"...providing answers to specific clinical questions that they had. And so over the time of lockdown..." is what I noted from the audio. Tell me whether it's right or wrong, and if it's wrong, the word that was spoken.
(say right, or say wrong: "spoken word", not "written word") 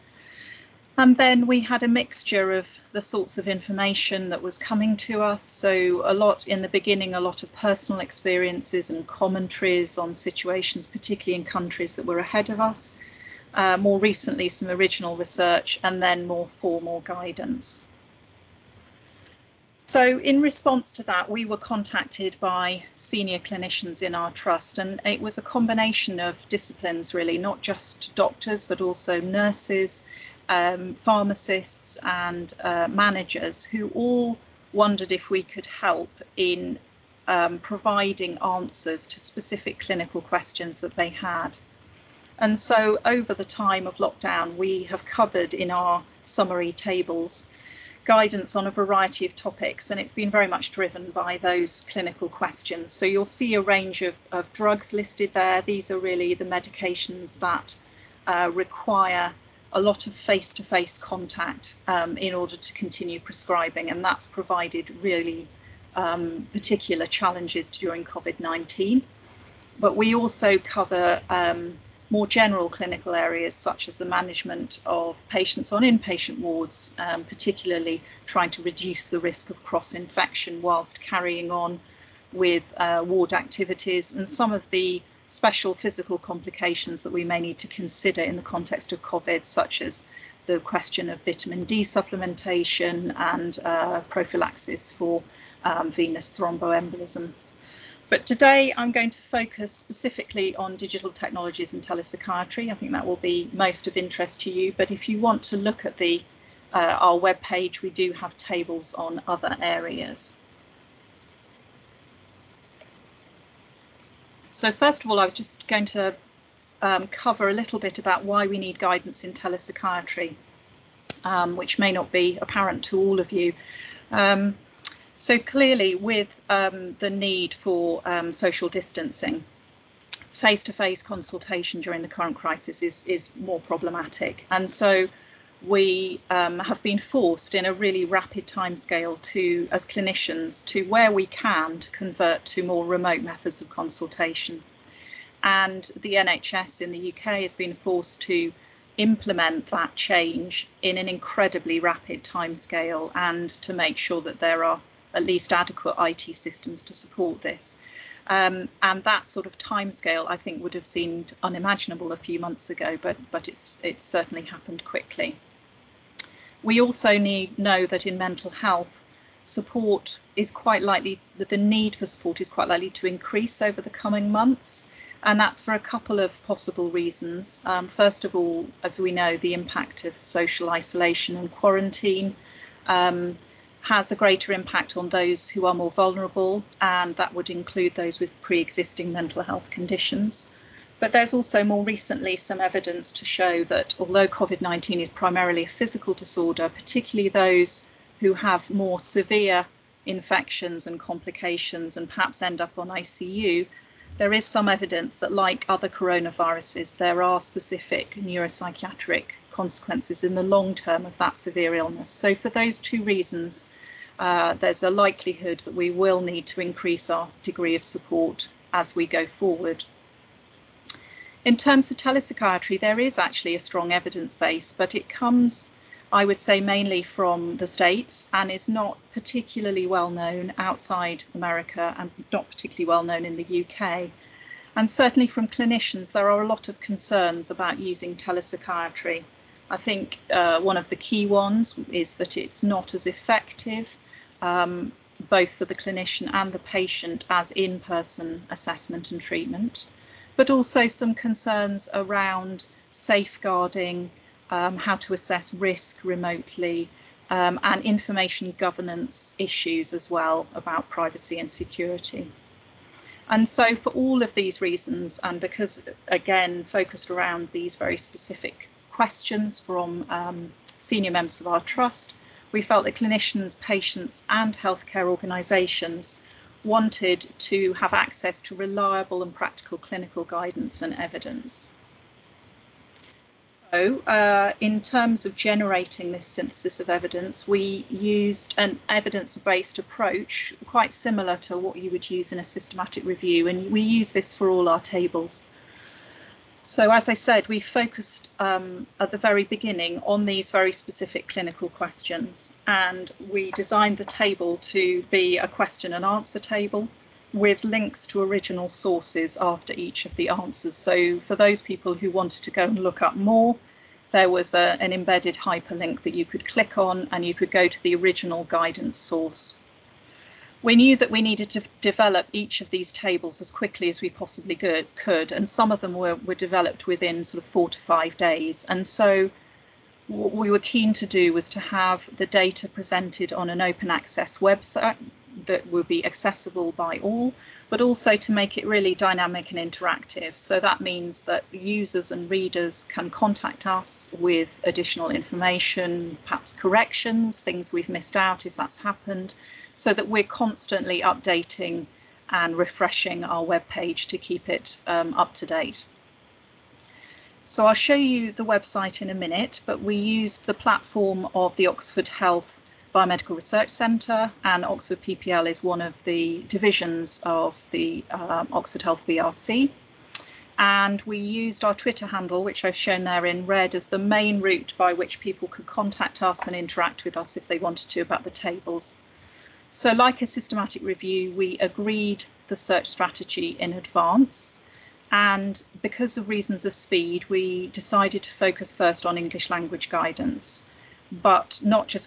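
right.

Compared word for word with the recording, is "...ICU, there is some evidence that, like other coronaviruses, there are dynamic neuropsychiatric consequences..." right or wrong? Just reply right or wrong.
wrong.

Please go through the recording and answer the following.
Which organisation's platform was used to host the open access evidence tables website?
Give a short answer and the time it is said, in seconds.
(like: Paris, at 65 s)
Oxford Health Biomedical Research Centre, at 361 s.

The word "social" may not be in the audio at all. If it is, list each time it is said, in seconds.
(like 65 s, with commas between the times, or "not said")
128 s, 180 s.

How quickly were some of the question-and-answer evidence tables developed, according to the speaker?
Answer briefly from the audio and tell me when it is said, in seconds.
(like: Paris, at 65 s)
4 to 5 days, at 327 s.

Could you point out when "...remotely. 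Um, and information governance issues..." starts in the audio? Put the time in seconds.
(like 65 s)
256 s.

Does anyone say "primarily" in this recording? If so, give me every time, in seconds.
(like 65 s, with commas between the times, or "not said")
195 s.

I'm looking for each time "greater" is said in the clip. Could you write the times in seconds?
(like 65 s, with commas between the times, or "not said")
184 s.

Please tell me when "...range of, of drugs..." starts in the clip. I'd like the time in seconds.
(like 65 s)
53 s.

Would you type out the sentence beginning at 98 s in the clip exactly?
But today I'm going to focus specifically on digital technologies and telepsychiatry.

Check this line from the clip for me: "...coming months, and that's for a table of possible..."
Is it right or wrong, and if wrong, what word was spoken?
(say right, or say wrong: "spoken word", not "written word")
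wrong: "couple", not "table".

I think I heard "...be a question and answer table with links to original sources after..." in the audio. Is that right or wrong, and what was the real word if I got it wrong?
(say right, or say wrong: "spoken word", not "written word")
right.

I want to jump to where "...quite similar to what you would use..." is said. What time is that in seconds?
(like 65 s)
290 s.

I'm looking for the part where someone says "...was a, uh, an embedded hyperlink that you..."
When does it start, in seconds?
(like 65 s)
314 s.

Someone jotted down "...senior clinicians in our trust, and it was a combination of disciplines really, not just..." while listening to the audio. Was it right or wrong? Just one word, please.
right.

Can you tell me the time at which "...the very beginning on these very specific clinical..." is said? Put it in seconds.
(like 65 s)
299 s.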